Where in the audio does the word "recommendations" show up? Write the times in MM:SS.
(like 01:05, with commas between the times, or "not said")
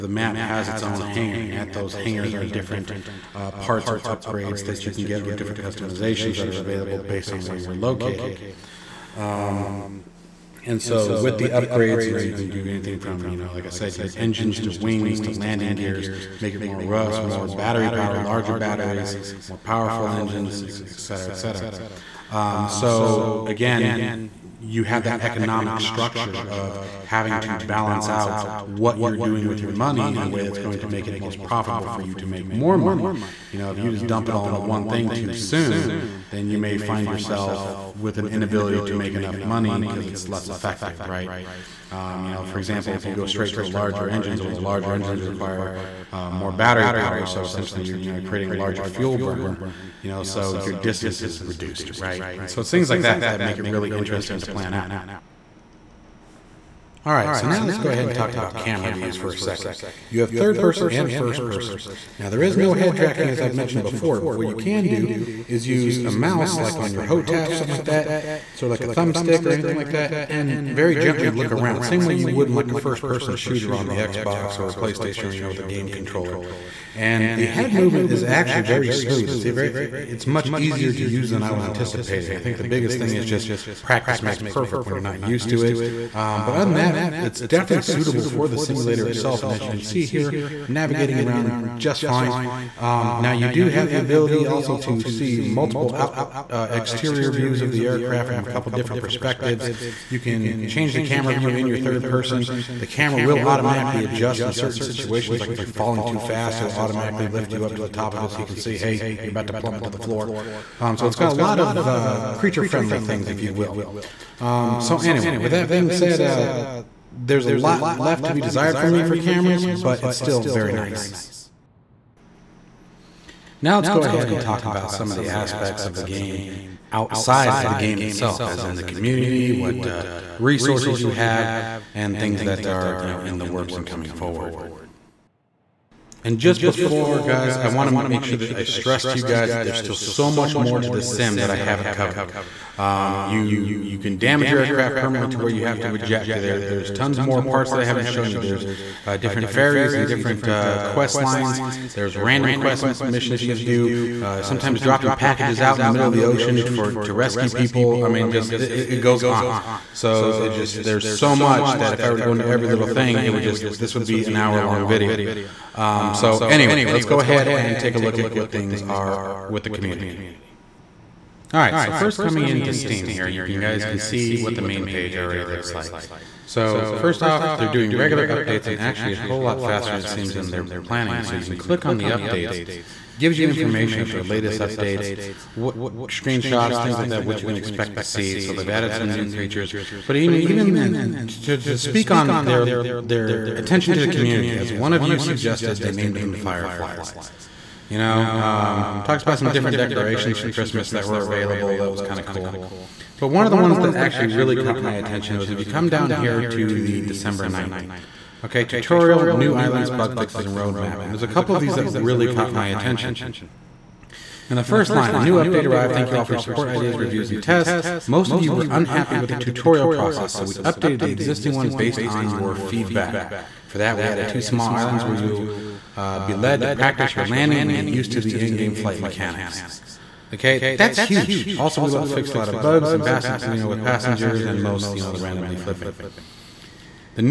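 not said.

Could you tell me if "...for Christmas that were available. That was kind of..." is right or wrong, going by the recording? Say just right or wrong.
right.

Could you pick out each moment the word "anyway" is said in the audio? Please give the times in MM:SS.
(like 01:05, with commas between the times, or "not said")
01:54, 02:46.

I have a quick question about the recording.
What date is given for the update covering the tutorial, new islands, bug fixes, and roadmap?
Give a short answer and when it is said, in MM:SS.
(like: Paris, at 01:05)
December 9th, at 03:27.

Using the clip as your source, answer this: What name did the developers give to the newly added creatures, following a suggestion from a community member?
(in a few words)
Fireflies.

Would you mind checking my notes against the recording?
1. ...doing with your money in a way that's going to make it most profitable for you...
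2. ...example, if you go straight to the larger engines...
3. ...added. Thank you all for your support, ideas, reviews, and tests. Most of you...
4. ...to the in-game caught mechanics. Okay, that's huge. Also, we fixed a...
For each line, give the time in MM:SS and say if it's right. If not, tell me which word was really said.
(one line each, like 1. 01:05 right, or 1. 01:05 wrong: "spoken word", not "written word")
1. 00:29 right
2. 00:42 right
3. 03:35 wrong: "arrived", not "added"
4. 03:48 wrong: "flight", not "caught".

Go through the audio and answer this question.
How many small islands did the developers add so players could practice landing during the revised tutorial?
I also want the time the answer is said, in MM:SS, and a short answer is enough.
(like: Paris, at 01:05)
2, at 03:44.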